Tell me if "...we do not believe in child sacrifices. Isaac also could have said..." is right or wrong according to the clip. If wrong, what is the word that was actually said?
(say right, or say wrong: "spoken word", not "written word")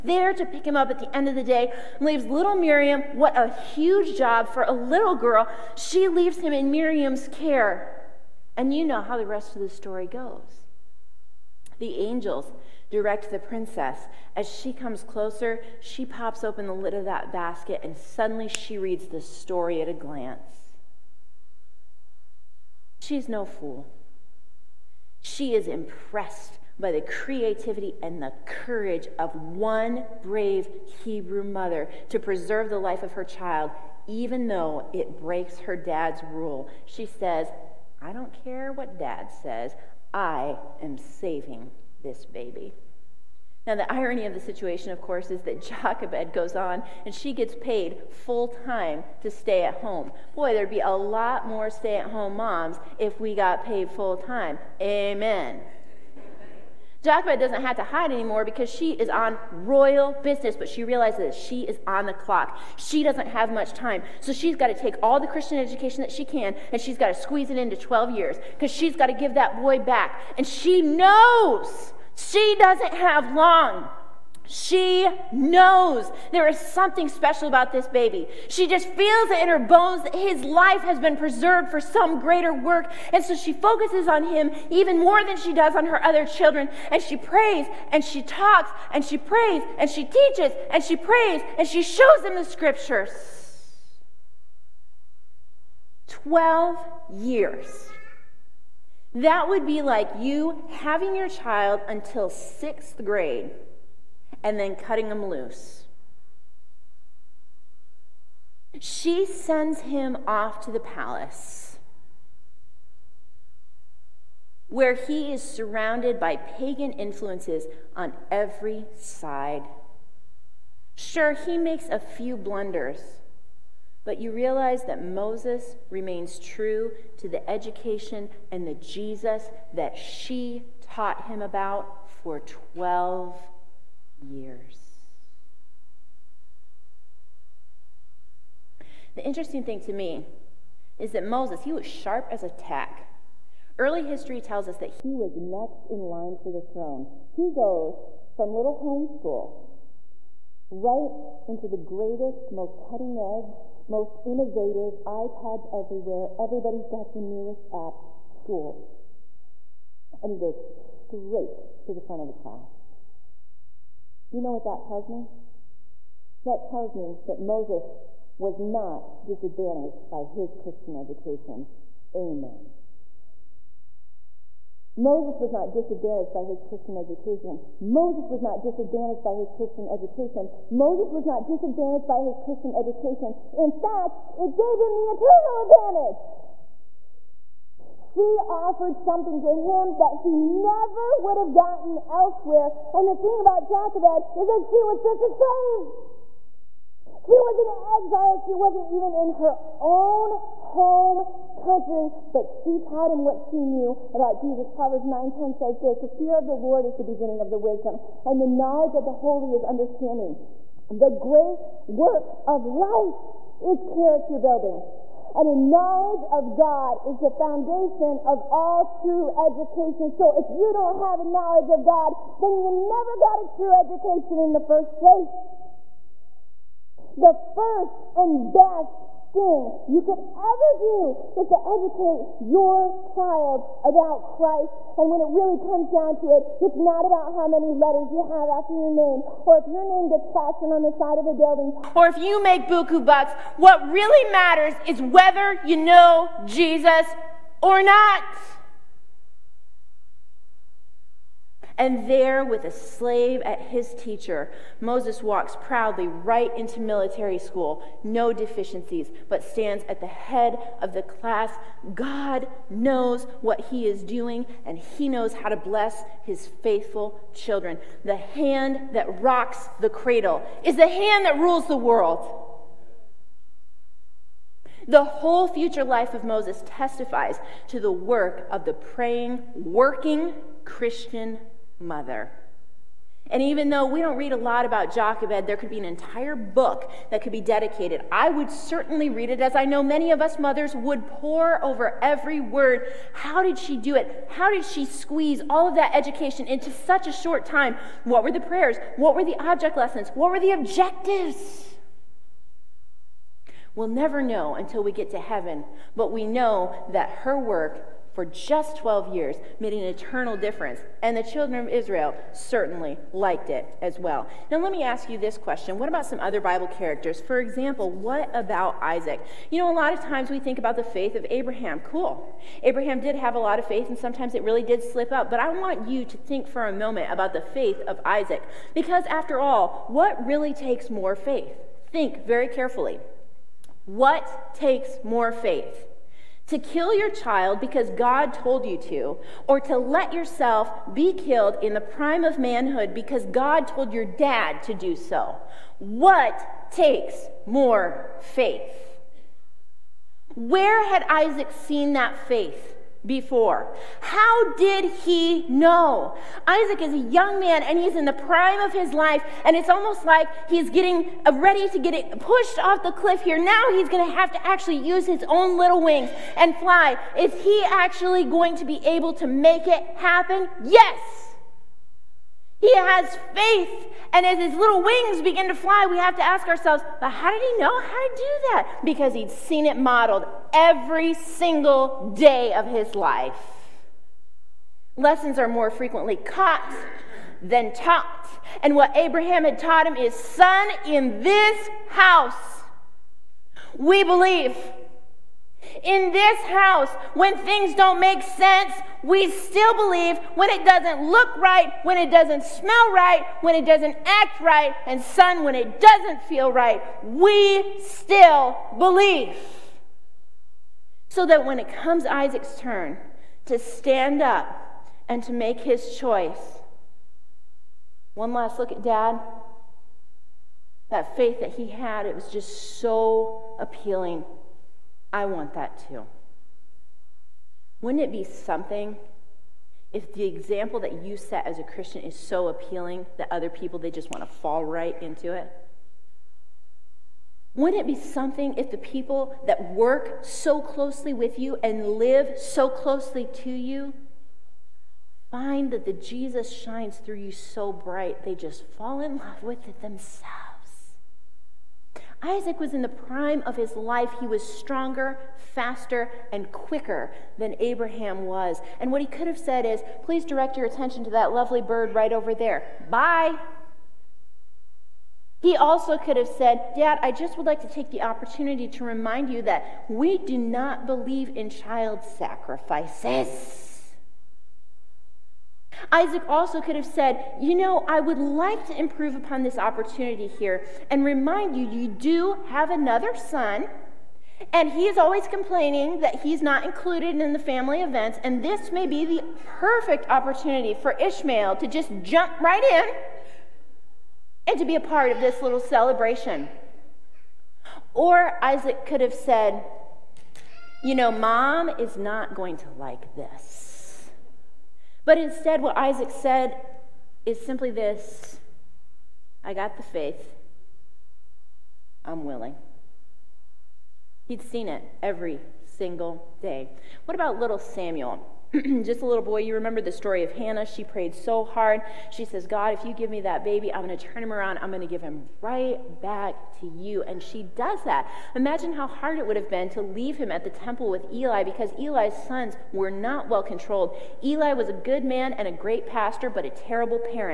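right.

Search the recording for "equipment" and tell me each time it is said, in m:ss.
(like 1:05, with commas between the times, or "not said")
not said.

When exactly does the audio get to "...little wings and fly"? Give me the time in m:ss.
6:05.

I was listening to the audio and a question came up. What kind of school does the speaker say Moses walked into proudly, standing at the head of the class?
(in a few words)
military school.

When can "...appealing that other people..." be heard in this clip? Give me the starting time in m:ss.
7:12.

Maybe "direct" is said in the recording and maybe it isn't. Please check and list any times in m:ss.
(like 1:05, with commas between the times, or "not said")
0:12, 7:40.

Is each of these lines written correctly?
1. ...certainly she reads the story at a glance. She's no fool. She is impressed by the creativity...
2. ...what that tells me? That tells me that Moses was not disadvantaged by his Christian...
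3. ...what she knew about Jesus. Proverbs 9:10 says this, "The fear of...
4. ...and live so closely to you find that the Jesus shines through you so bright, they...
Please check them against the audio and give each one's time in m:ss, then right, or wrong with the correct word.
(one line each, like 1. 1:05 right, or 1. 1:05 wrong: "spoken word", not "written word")
1. 0:17 wrong: "suddenly", not "certainly"
2. 2:44 right
3. 3:23 right
4. 7:21 right.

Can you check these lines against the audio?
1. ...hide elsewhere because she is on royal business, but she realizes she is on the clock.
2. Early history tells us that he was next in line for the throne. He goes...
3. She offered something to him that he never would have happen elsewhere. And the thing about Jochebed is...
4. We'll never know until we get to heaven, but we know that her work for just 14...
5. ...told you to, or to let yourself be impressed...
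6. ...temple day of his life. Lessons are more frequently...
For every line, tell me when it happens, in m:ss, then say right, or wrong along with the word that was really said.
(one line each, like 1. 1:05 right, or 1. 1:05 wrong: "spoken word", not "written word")
1. 0:57 wrong: "anymore", not "elsewhere"
2. 2:23 right
3. 3:07 wrong: "gotten", not "happen"
4. 5:03 wrong: "12", not "14"
5. 5:38 wrong: "killed", not "impressed"
6. 6:21 wrong: "single", not "temple".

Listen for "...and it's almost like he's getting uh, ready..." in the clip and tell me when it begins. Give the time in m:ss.
5:59.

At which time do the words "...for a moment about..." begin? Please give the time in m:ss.
5:26.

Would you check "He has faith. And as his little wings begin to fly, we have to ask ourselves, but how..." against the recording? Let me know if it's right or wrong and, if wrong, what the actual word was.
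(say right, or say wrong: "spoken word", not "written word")
right.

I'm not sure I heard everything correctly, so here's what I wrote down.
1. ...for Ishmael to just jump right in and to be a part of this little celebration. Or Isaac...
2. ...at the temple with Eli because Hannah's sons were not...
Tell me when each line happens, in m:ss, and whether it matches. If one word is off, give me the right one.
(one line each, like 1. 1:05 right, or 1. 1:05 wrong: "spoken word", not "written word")
1. 8:10 right
2. 8:50 wrong: "Eli", not "Hannah".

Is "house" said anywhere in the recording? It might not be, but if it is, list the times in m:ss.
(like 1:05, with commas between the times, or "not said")
6:31, 6:36.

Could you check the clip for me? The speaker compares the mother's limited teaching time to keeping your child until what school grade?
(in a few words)
sixth grade.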